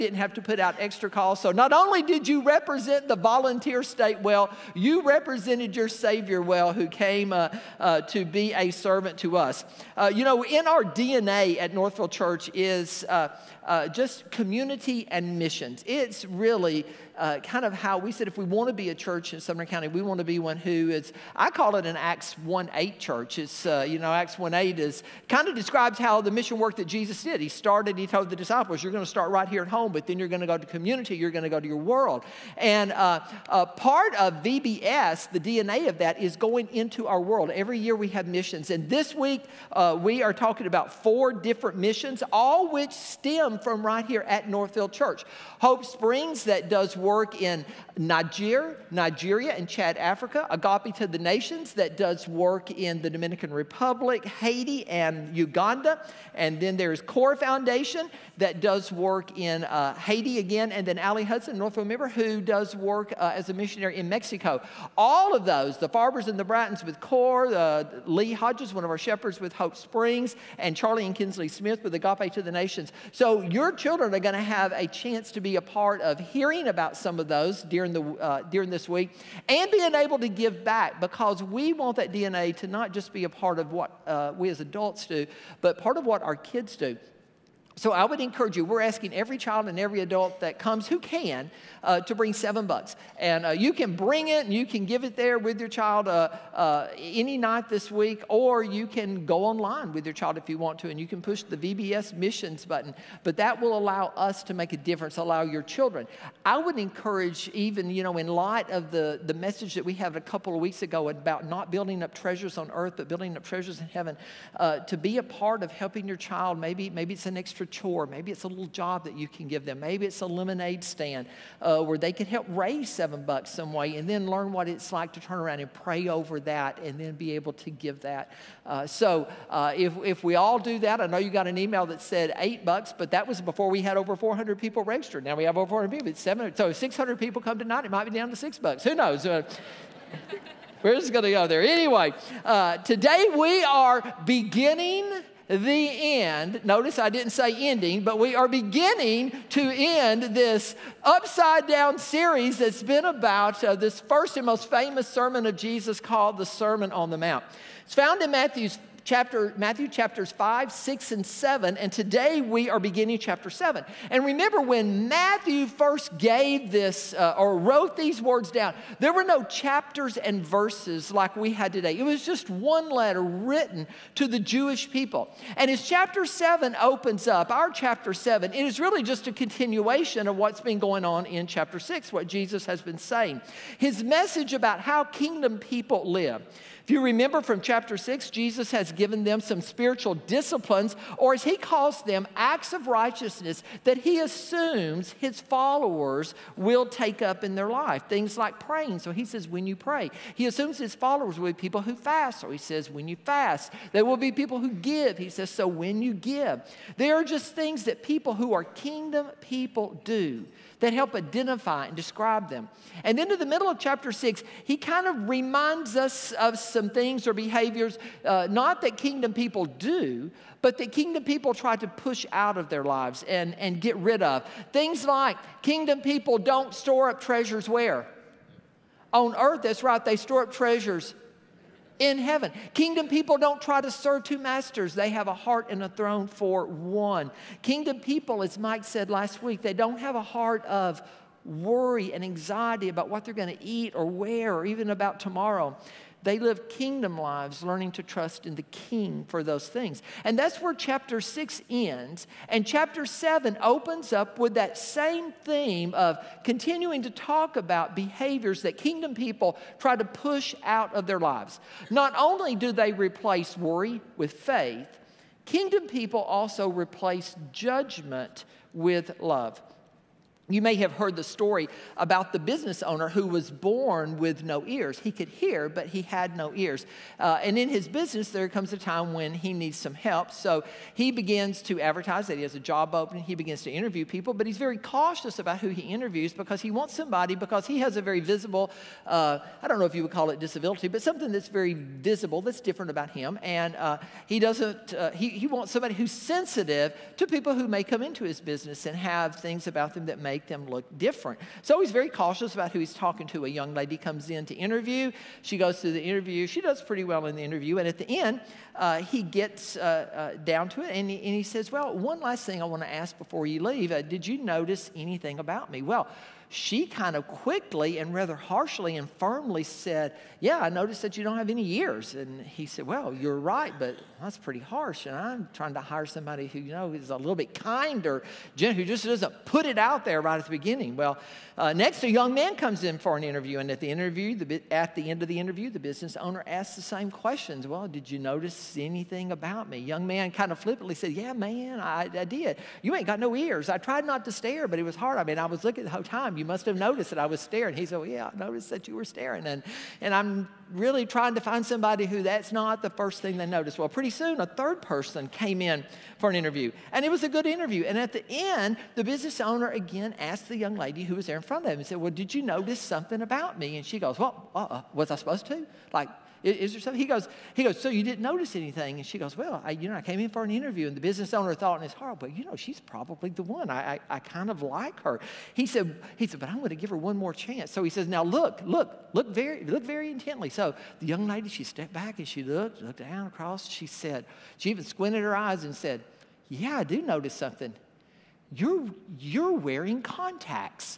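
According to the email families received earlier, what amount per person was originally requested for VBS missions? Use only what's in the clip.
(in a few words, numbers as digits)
$8.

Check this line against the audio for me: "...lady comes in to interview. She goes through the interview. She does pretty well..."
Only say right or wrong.
right.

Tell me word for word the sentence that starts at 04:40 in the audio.
So he begins to advertise that he has a job opening.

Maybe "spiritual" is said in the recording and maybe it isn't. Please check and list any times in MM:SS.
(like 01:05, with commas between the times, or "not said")
03:09.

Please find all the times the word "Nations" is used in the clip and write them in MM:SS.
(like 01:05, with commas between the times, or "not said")
00:51, 01:12.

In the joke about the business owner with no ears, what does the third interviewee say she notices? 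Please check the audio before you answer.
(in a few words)
Contacts.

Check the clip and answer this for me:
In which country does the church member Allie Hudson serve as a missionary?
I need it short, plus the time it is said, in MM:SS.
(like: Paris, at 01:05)
Mexico, at 01:04.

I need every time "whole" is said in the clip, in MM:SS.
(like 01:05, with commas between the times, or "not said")
05:45.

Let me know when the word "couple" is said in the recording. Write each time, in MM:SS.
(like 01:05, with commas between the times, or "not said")
01:50.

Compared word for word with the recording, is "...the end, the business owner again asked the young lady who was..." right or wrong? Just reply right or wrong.
right.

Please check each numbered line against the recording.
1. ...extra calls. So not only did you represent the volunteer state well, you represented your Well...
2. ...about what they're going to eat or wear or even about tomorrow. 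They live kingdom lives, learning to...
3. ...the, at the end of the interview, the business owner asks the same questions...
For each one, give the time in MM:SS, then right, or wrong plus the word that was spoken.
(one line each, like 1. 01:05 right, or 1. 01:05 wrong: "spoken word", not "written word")
1. 00:00 wrong: "Savior", not "Well"
2. 04:02 right
3. 05:34 right.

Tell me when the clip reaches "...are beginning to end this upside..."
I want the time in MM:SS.
02:28.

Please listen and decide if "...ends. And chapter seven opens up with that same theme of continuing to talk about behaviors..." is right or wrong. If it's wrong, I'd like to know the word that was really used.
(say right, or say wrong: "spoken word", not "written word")
right.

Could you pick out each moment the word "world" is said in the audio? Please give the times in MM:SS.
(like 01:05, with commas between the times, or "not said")
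00:31, 00:37.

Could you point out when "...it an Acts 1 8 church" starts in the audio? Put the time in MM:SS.
00:21.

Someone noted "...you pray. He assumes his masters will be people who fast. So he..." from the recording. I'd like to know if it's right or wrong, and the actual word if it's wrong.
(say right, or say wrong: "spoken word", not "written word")
wrong: "followers", not "masters".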